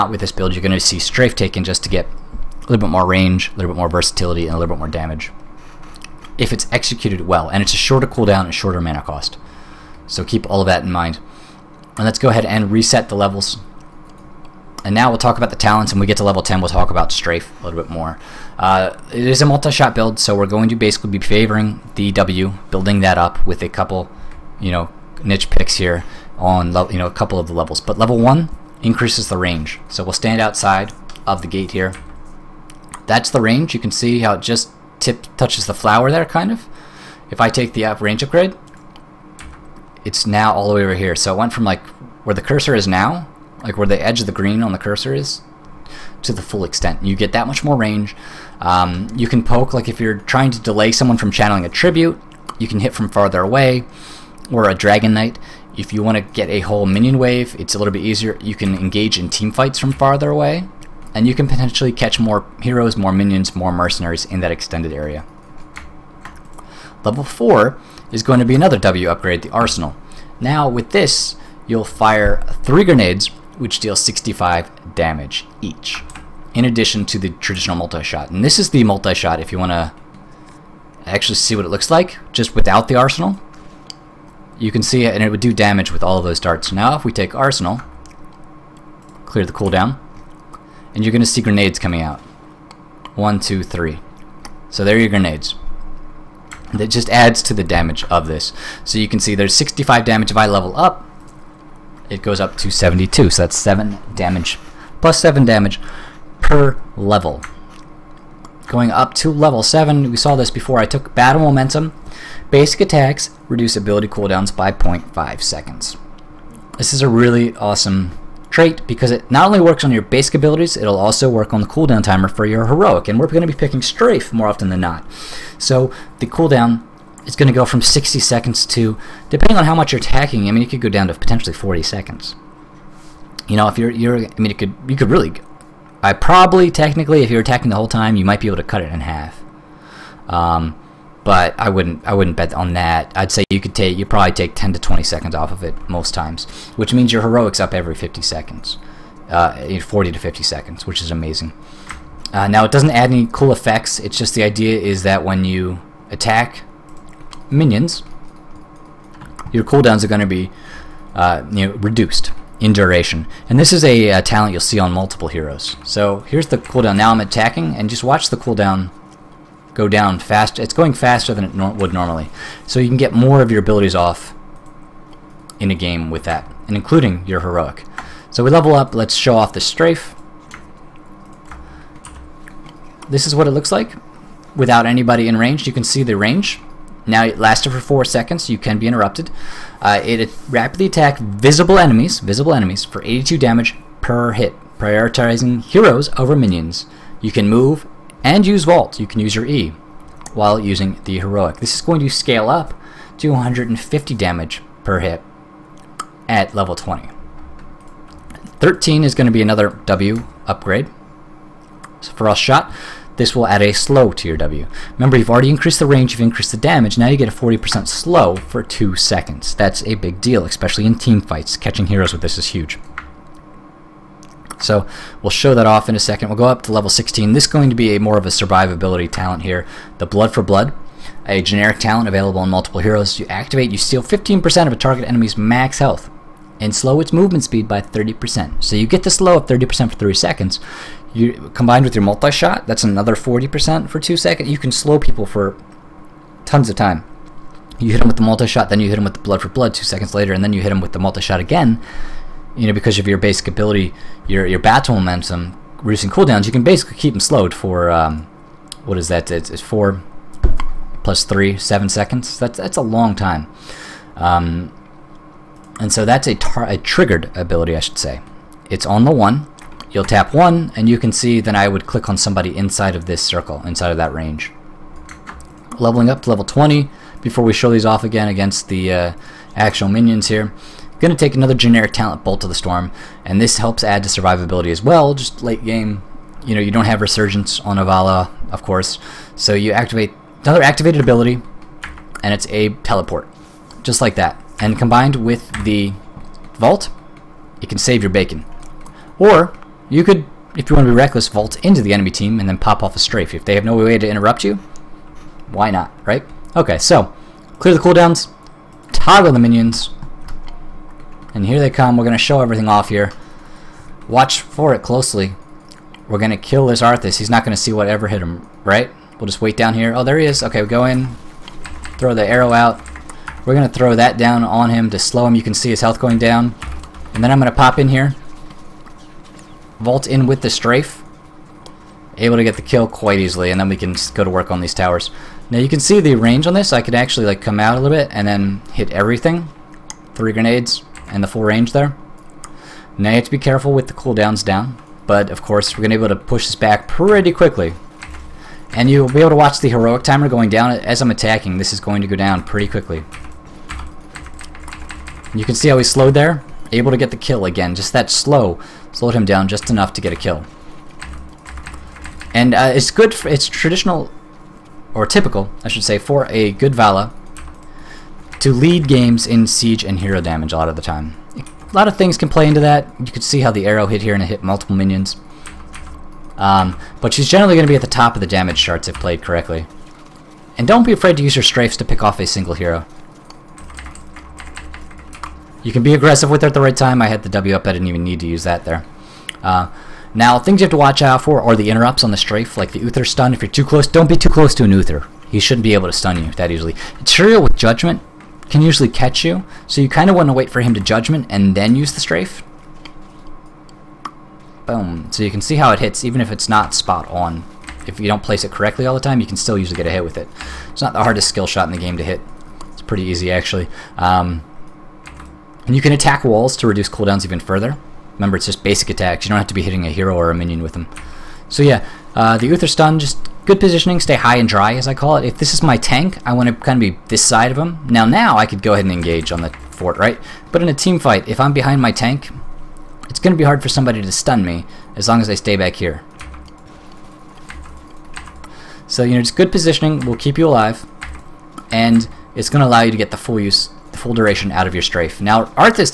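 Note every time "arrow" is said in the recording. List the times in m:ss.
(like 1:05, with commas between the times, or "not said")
5:22, 6:13.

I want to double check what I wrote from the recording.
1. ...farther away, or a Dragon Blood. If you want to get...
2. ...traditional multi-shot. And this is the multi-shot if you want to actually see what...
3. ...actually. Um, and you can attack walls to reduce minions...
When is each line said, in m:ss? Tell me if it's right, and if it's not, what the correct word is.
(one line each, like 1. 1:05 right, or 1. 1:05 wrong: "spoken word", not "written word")
1. 0:53 wrong: "Knight", not "Blood"
2. 1:17 right
3. 6:53 wrong: "cooldowns", not "minions".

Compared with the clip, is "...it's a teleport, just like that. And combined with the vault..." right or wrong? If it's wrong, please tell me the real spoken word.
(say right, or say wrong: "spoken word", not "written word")
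right.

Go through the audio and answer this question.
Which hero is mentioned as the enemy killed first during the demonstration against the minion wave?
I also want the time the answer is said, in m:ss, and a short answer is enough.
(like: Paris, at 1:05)
Arthas, at 5:16.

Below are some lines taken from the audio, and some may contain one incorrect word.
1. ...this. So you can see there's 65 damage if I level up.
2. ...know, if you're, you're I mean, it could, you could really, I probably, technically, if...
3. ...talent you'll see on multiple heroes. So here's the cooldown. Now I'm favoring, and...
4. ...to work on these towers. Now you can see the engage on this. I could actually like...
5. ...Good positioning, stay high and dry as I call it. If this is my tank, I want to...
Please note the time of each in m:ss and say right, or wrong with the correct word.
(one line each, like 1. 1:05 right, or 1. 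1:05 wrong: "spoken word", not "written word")
1. 1:38 right
2. 2:13 right
3. 2:44 wrong: "attacking", not "favoring"
4. 5:34 wrong: "range", not "engage"
5. 7:03 right.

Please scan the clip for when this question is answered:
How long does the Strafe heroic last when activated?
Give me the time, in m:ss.
3:07.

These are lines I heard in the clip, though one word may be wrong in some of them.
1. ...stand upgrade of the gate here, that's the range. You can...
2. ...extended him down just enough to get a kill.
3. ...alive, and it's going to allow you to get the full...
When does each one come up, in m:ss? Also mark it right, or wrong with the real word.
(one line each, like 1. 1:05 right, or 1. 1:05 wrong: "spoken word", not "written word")
1. 0:30 wrong: "outside", not "upgrade"
2. 5:58 wrong: "slowed", not "extended"
3. 7:20 right.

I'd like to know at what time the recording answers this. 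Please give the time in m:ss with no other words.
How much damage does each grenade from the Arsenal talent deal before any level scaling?
1:13.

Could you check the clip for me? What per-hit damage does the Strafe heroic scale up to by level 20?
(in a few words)
150.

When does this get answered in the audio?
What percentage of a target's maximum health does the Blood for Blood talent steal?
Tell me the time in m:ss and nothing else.
3:54.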